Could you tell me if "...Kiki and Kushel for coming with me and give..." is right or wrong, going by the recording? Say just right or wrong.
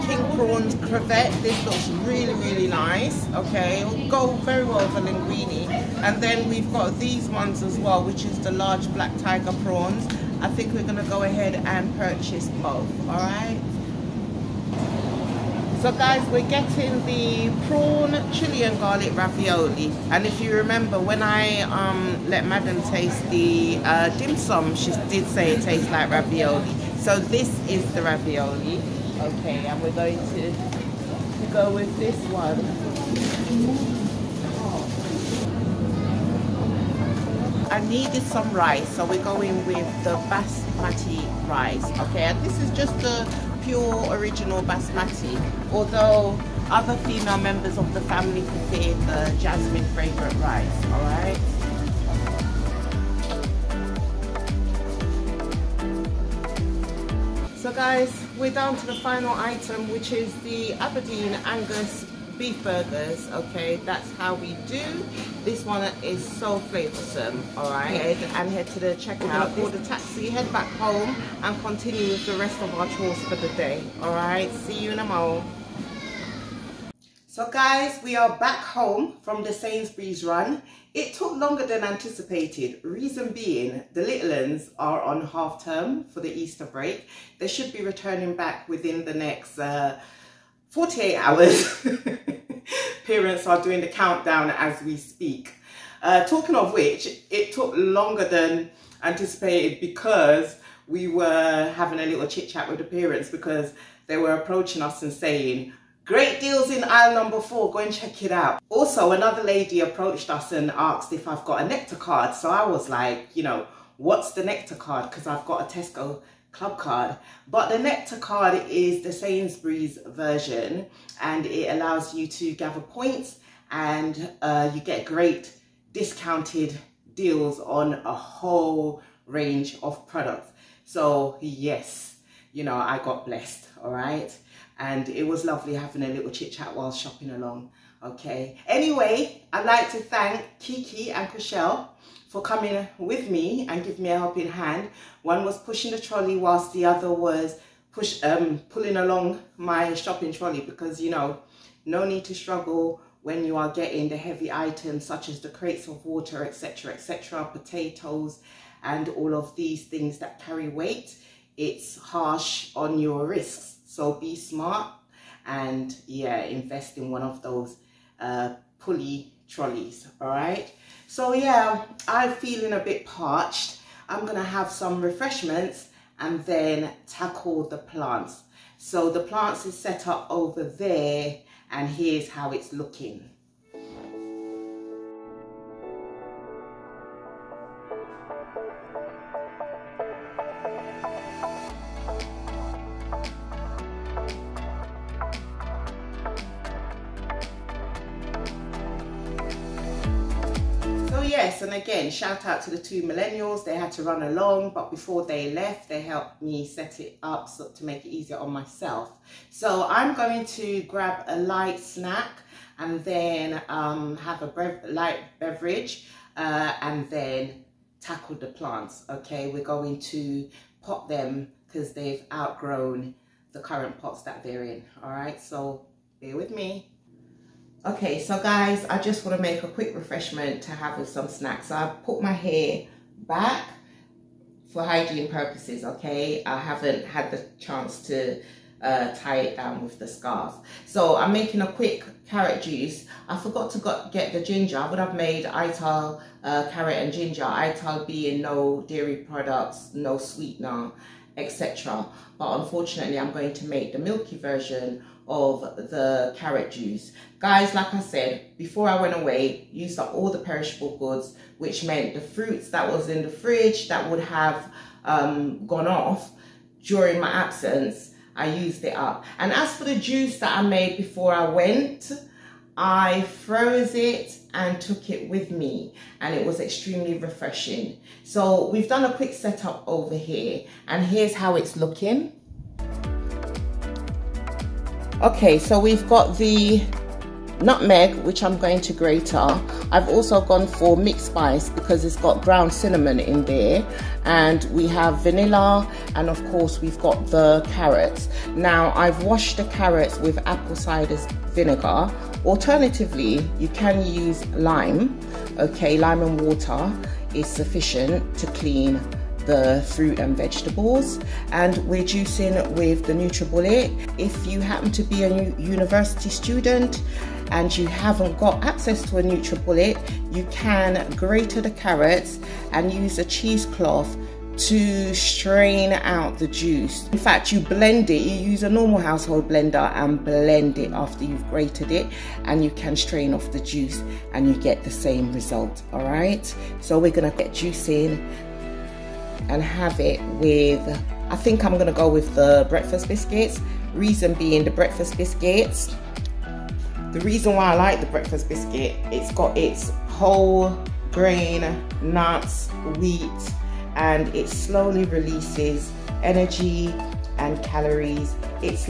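right.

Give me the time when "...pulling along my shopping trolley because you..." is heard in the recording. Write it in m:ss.
2:28.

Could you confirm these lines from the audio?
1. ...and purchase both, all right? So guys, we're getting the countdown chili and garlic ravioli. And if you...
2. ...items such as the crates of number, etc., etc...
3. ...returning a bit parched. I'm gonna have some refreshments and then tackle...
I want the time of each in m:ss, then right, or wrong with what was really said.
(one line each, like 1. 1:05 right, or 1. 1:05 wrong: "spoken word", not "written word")
1. 0:11 wrong: "prawn", not "countdown"
2. 2:34 wrong: "water", not "number"
3. 2:52 wrong: "feeling", not "returning".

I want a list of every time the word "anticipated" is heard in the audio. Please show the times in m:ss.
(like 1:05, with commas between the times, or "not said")
1:21, 1:39.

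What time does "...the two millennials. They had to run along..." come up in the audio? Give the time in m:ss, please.
3:22.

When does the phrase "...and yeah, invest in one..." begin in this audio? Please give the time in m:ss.
2:45.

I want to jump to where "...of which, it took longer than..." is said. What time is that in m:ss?
1:36.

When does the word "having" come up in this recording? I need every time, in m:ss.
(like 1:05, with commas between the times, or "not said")
1:41, 2:15.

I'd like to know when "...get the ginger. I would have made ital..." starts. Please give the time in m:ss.
4:04.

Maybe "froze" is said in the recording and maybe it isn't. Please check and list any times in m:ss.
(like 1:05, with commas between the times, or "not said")
4:33.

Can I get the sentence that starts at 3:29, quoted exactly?
So I'm going to grab a light snack and then um, have a brev light beverage uh, and then tackle the plants.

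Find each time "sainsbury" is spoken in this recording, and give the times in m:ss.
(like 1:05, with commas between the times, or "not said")
1:19, 1:59.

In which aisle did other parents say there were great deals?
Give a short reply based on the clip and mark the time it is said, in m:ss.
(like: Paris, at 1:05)
4, at 1:46.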